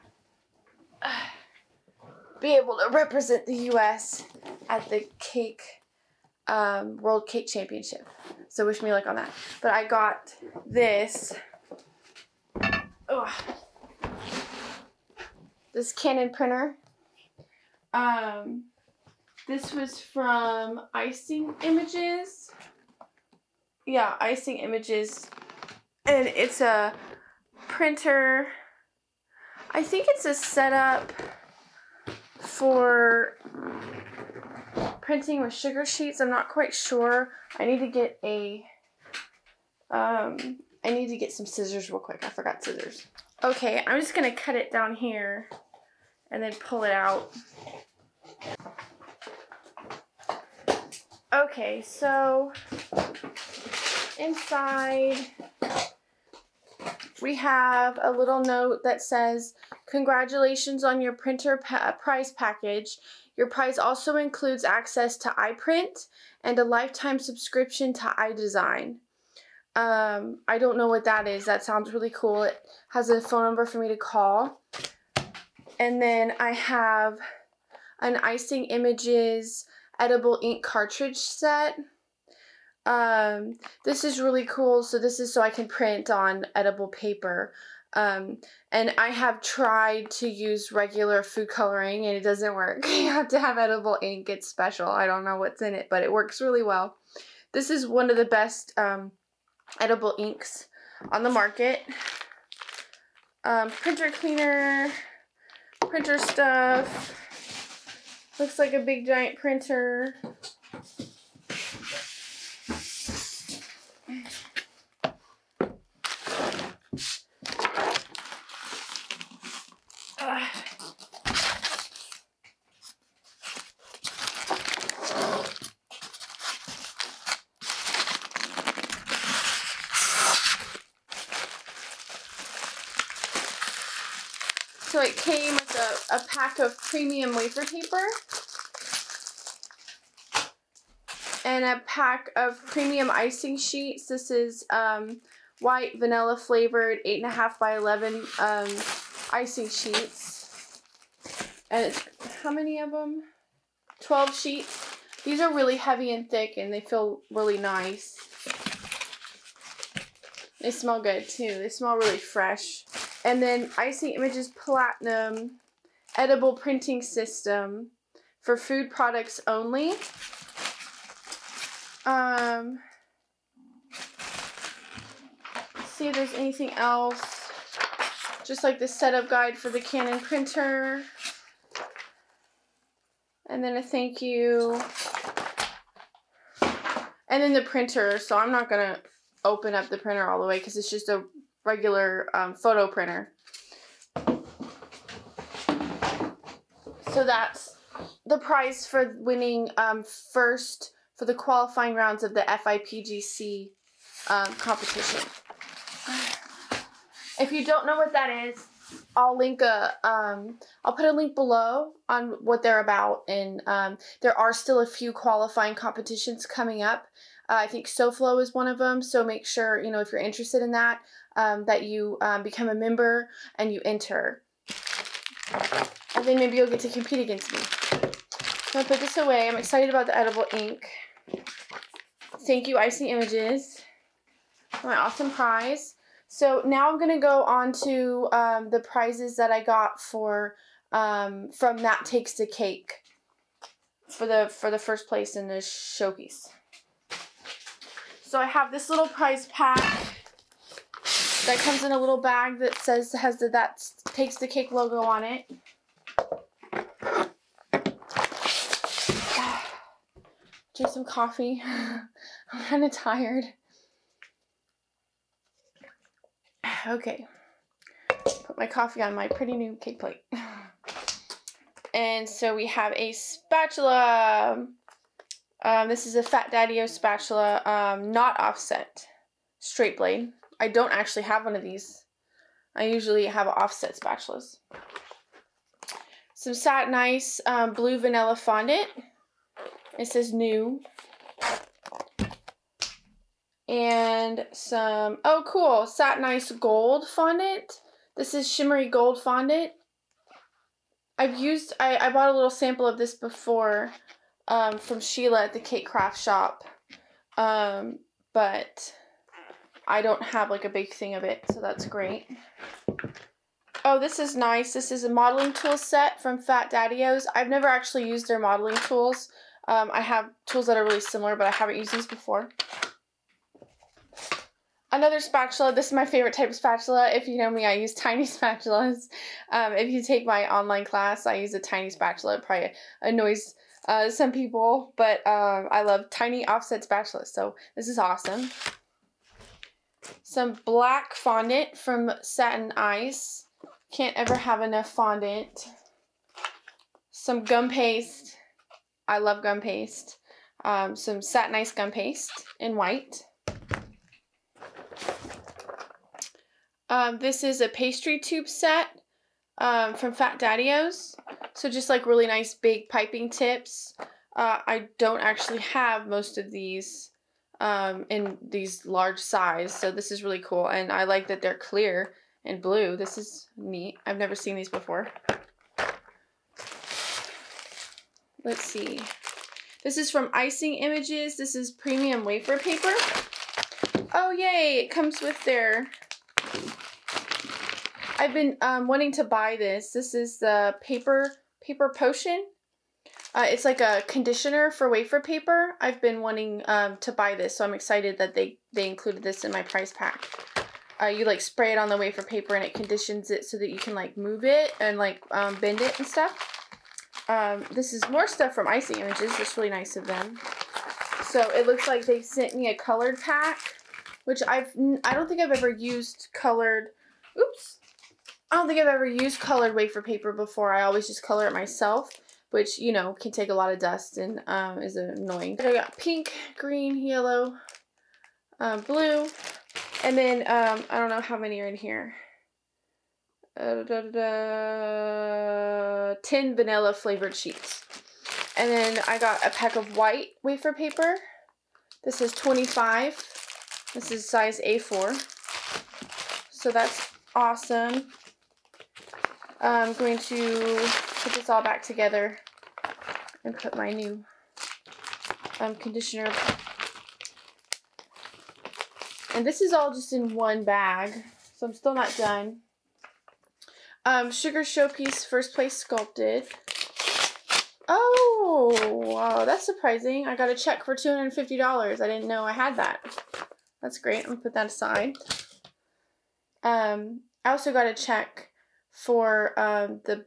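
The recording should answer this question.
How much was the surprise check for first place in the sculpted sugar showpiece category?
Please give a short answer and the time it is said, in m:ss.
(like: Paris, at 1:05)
$250, at 7:50.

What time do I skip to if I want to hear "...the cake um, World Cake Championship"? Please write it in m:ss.
0:04.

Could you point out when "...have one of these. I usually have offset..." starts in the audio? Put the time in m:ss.
4:41.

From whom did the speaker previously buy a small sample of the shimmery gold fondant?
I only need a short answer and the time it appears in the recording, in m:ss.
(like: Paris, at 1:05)
Sheila, at 5:04.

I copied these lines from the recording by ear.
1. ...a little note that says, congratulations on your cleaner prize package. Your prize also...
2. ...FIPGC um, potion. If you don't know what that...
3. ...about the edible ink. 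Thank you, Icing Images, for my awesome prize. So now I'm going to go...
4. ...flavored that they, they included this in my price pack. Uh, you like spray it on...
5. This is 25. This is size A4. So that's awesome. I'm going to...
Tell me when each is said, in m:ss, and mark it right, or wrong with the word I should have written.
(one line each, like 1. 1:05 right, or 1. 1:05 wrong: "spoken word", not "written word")
1. 0:57 wrong: "printer", not "cleaner"
2. 3:22 wrong: "competition", not "potion"
3. 3:49 right
4. 6:37 wrong: "excited", not "flavored"
5. 7:22 right.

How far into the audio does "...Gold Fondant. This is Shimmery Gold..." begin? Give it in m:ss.
4:56.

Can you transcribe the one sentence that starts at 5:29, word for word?
Um, if you take my online class, I use a tiny spatula.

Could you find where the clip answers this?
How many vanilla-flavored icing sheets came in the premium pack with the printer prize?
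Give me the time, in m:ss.
2:34.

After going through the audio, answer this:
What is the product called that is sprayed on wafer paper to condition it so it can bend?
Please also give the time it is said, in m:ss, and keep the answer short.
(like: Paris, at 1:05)
wafer paper potion, at 6:30.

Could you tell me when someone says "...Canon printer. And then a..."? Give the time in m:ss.
2:59.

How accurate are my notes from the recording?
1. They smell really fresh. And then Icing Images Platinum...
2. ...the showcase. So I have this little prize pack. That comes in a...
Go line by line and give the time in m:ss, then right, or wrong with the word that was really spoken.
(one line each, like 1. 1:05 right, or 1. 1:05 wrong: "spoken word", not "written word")
1. 2:41 right
2. 4:05 right.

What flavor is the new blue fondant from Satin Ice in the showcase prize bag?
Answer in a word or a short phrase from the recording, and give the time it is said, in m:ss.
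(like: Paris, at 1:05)
Blue Vanilla, at 4:47.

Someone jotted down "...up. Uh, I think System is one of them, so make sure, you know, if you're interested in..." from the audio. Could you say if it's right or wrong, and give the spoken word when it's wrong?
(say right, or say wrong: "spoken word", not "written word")
wrong: "SoFlo", not "System".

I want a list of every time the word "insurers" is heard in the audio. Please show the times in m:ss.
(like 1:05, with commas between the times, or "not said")
not said.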